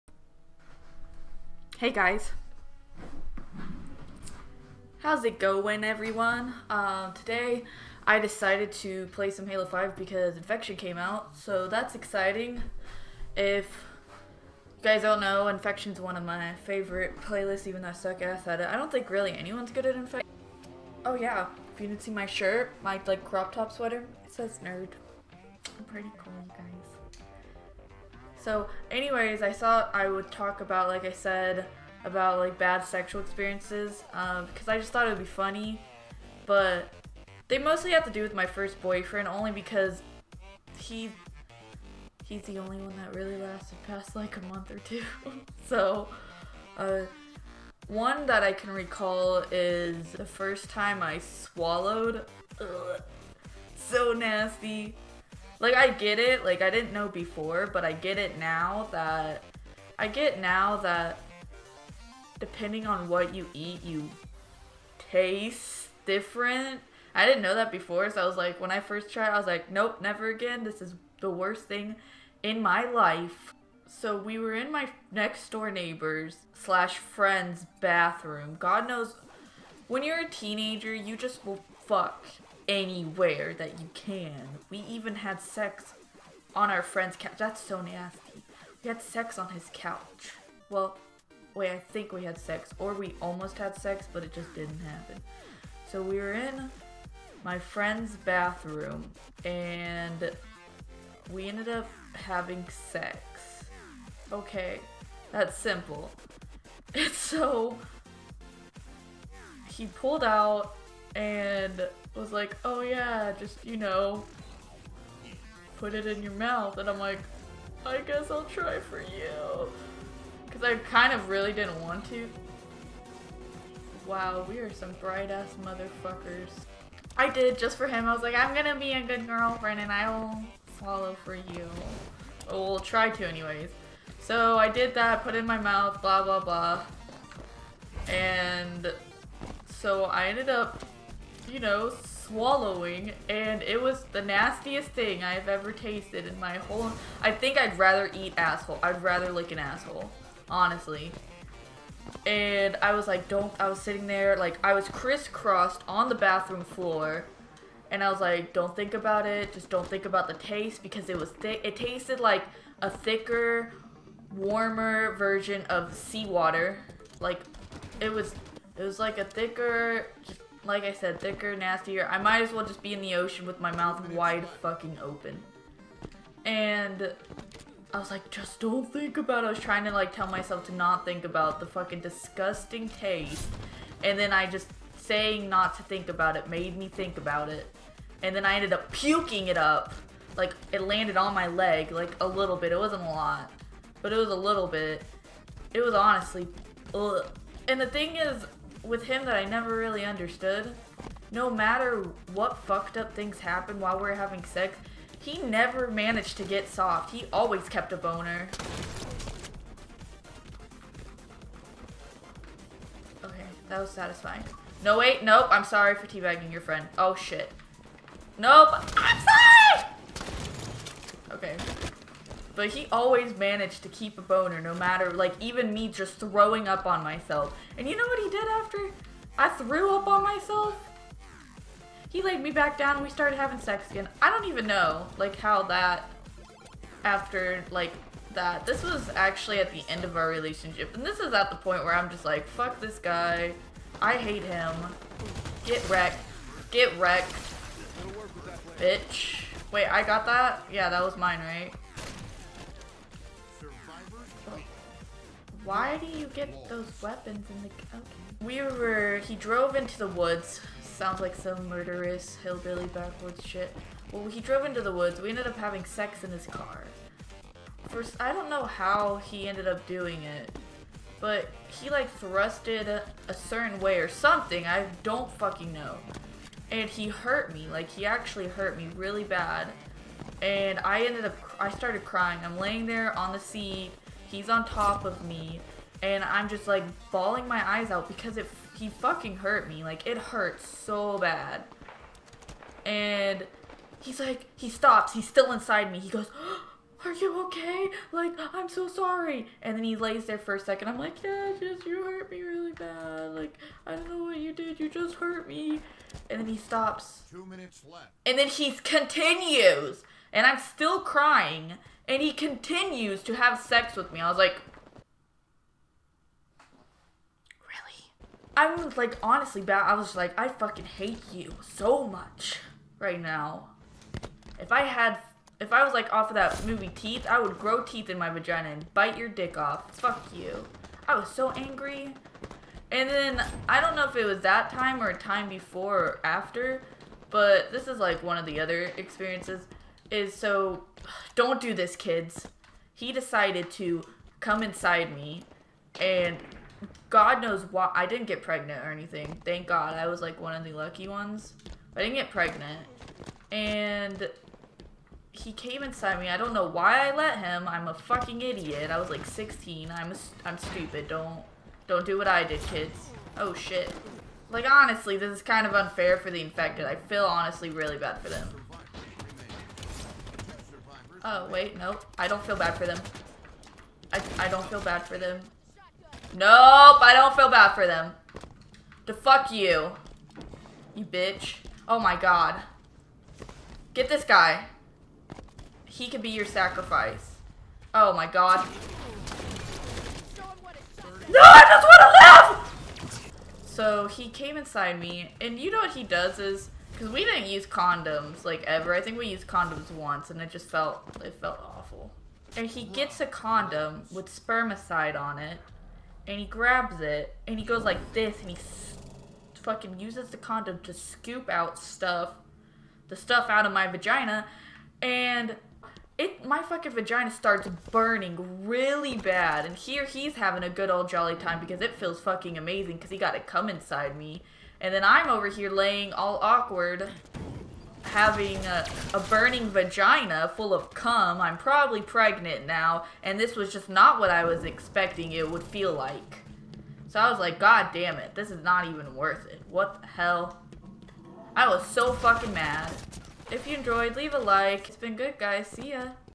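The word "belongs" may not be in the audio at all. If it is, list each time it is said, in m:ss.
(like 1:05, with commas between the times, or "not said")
not said.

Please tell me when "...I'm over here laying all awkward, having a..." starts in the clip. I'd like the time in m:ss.
7:05.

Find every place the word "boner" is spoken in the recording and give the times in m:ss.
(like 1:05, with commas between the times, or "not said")
3:27, 3:44.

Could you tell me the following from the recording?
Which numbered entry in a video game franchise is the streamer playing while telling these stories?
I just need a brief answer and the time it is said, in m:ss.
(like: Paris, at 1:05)
Halo 5, at 0:09.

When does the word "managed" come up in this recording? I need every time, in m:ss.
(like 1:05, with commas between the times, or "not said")
3:25, 3:43.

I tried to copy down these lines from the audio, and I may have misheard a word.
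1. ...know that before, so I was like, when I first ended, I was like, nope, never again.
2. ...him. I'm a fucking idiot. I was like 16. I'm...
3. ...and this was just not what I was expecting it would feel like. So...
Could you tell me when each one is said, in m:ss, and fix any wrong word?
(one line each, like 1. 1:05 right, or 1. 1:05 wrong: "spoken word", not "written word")
1. 1:07 wrong: "tried", not "ended"
2. 5:57 right
3. 7:13 right.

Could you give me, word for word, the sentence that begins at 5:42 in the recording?
He decided to come inside me and God knows why I didn't get pregnant or anything.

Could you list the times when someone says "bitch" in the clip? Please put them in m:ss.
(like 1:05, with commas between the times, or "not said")
4:08, 6:21.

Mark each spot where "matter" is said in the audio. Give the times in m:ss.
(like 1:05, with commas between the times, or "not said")
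3:21, 3:44.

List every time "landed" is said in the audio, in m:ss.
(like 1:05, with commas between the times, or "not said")
3:10.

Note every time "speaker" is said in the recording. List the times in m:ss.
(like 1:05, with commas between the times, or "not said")
not said.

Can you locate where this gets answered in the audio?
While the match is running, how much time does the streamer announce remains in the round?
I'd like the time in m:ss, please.
5:07.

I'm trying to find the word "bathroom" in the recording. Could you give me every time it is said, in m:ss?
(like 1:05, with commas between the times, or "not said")
1:17, 1:38, 2:36.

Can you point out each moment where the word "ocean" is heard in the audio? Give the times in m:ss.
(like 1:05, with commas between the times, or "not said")
2:53.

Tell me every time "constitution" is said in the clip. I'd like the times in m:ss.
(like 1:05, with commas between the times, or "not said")
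not said.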